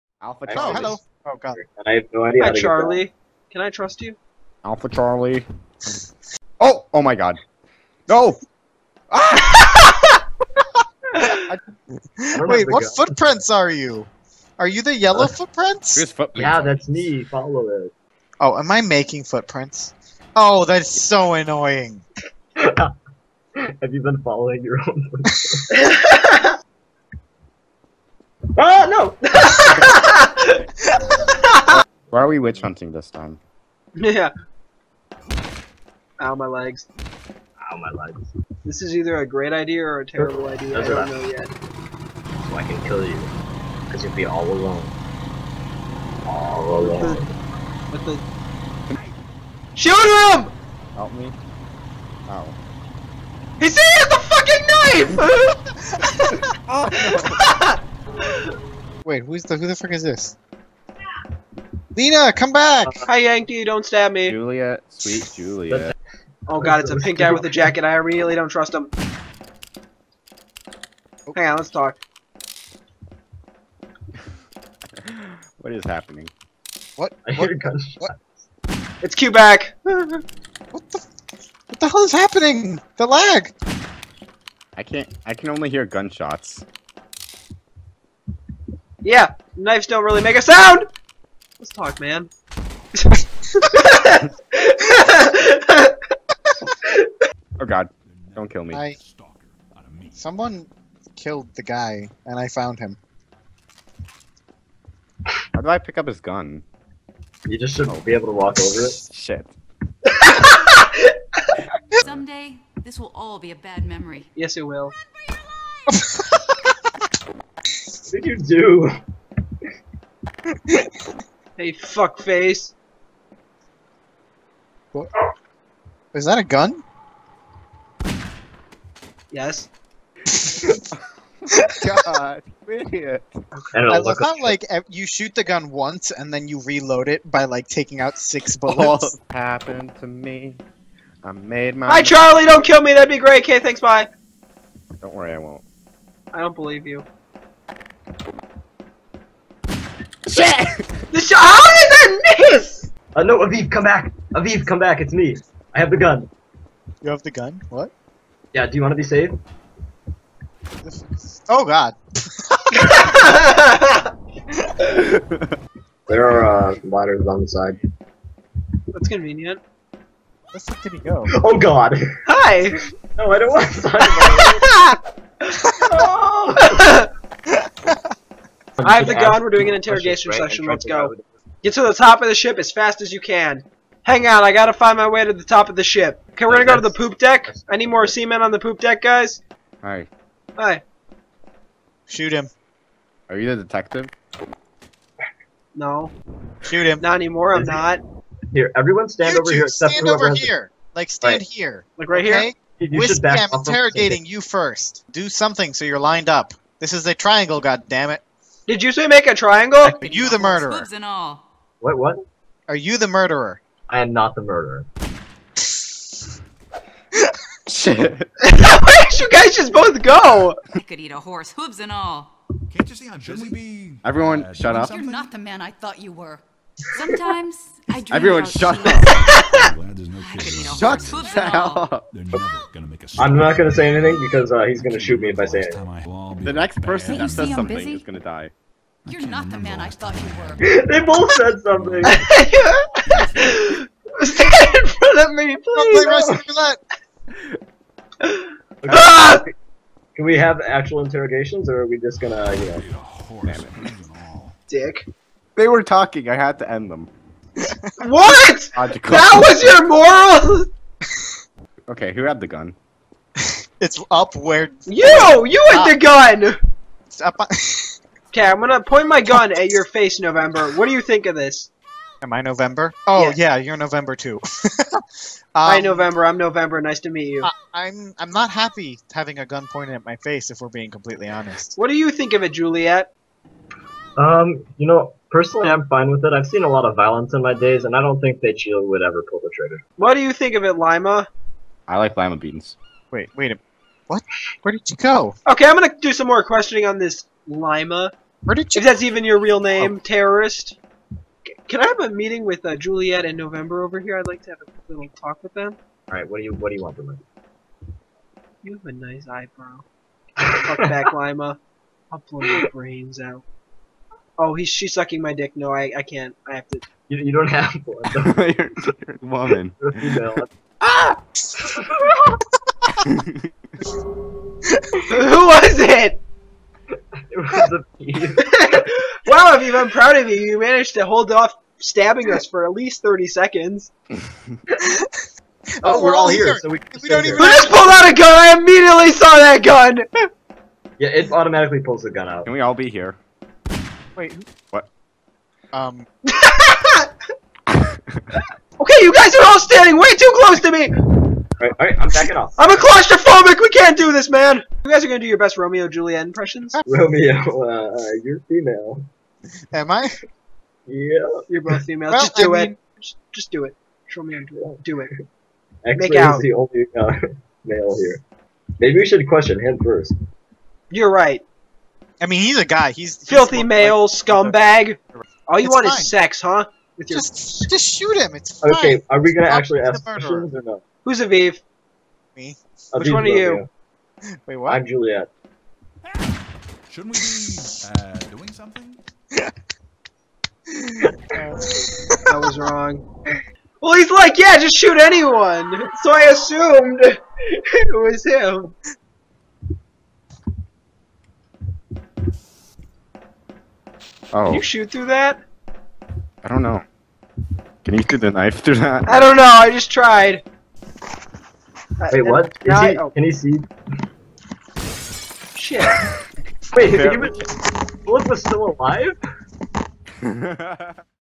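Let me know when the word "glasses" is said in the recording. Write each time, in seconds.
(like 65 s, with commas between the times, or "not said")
not said.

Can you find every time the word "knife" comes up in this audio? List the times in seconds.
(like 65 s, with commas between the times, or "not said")
55 s, 408 s.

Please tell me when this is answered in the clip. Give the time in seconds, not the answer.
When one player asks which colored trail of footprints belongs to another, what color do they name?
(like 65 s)
14 s.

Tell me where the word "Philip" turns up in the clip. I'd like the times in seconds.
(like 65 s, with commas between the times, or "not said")
418 s.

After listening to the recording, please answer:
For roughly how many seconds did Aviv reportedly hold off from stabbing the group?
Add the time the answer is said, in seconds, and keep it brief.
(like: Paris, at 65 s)
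30, at 333 s.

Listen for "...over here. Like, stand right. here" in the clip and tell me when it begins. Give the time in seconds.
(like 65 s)
200 s.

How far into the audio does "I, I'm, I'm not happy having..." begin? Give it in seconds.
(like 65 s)
277 s.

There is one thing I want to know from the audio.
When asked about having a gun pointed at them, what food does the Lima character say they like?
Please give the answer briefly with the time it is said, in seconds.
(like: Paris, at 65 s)
Lima beans, at 292 s.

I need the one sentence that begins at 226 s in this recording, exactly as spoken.
Sometimes I dream Everyone shut up.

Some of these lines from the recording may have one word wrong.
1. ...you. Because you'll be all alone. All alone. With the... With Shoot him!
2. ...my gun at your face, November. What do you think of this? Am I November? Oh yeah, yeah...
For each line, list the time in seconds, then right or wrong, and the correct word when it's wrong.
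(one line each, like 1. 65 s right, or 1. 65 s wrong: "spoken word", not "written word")
1. 43 s right
2. 269 s right.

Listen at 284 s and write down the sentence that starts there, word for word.
Um, you know, personally, I'm fine with it.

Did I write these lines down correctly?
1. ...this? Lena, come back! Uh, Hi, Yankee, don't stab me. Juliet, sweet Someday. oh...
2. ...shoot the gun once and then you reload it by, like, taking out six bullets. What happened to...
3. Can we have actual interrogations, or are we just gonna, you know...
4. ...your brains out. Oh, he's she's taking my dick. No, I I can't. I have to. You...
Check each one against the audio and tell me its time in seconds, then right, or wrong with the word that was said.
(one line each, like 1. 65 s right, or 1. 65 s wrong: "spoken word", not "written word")
1. 60 s wrong: "Juliet", not "Someday"
2. 135 s right
3. 250 s right
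4. 312 s wrong: "sucking", not "taking".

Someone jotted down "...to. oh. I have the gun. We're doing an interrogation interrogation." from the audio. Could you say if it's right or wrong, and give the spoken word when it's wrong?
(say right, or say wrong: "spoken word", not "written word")
wrong: "session", not "interrogation".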